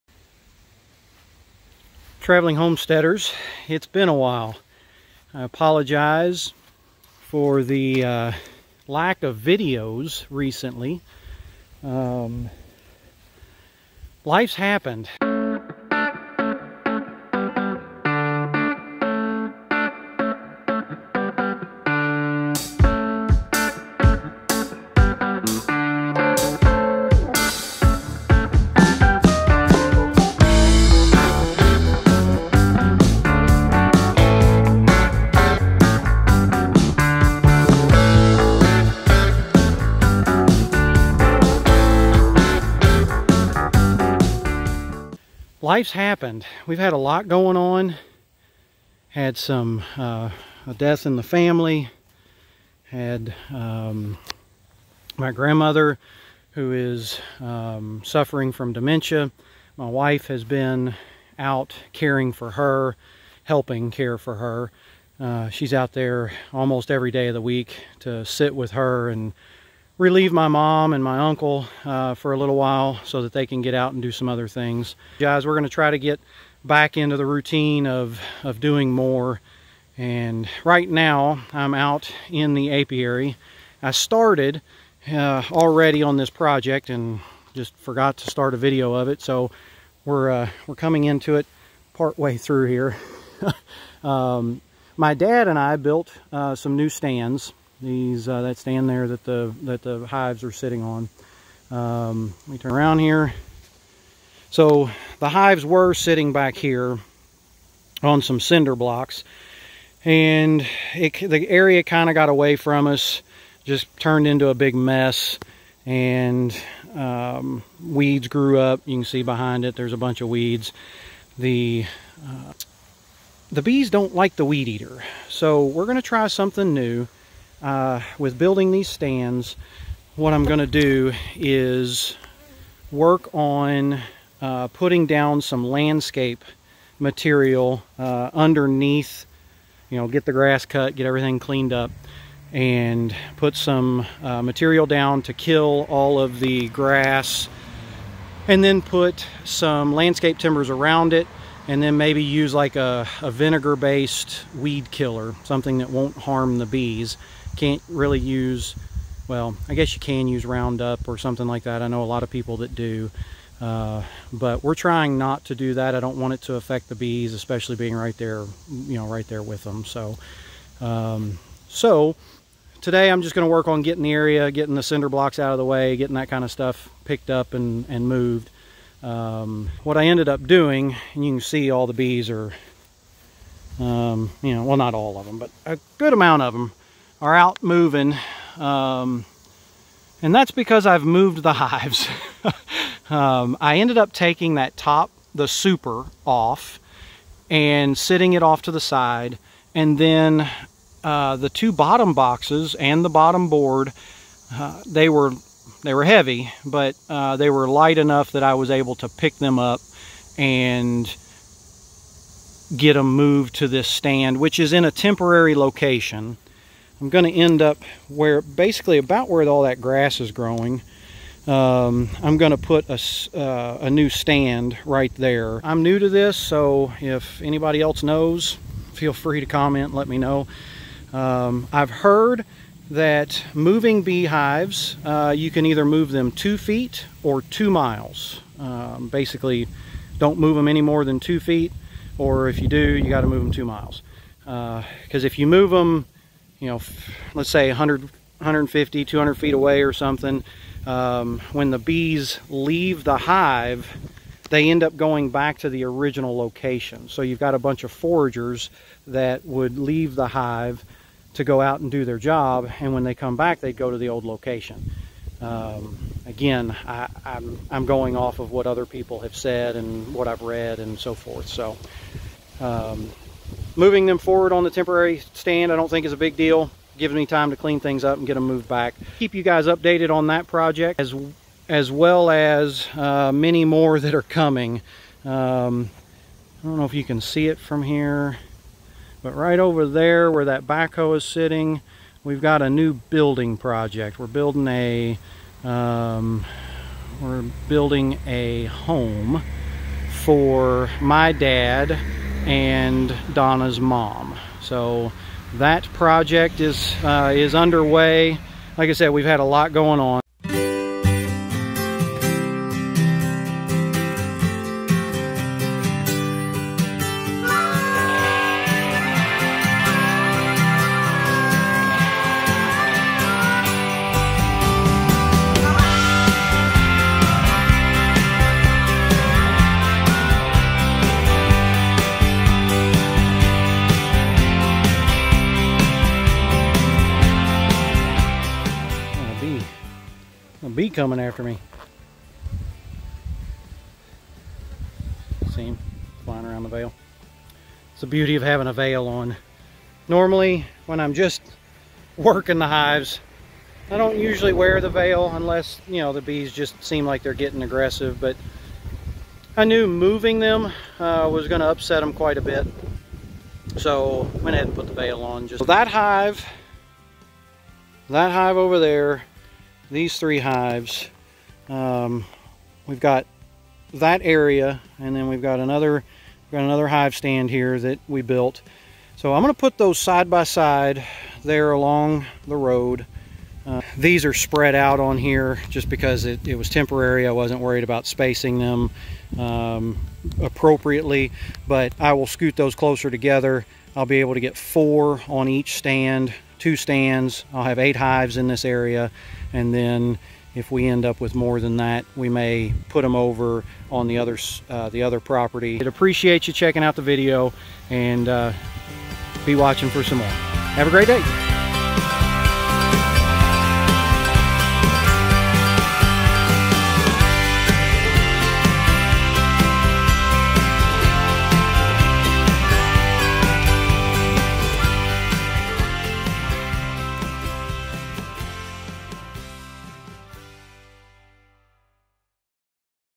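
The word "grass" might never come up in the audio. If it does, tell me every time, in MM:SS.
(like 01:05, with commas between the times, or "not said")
02:20, 02:26, 03:39.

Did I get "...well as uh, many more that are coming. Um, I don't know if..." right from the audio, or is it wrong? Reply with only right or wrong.
right.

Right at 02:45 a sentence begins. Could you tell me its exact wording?
I don't want it to affect the bees, especially being right there, you know, right there with them.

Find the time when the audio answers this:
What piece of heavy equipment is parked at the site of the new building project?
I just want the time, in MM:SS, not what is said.
04:50.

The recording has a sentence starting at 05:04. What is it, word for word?
So that project is, uh, is underway.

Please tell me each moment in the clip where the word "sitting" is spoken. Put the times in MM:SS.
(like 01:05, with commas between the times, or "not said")
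01:40, 01:45, 03:17, 04:51.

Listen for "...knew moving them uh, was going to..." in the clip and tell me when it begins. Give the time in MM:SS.
05:59.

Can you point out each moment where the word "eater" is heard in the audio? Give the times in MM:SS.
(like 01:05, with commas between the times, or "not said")
02:04.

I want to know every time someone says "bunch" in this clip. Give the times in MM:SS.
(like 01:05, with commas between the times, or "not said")
01:59, 04:17.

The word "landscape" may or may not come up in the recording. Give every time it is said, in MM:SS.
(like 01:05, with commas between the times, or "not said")
02:15, 02:29.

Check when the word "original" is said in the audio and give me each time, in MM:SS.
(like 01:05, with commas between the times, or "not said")
04:15.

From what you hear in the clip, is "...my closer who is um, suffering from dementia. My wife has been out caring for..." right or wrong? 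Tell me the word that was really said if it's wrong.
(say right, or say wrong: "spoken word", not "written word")
wrong: "grandmother", not "closer".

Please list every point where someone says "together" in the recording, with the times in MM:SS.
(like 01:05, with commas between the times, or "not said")
06:33.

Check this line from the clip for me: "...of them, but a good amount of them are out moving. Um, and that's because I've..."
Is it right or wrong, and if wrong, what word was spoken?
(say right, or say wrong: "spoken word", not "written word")
right.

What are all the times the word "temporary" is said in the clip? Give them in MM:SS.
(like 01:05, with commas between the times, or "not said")
03:34, 04:34, 06:26.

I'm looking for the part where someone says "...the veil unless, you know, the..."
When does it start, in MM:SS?
05:54.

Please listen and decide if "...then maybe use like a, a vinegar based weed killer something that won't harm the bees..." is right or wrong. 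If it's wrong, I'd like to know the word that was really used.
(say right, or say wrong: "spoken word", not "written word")
right.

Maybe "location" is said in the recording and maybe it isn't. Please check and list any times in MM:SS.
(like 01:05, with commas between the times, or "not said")
03:35, 04:16, 04:24.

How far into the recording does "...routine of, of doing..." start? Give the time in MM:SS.
01:17.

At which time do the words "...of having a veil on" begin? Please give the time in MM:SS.
05:48.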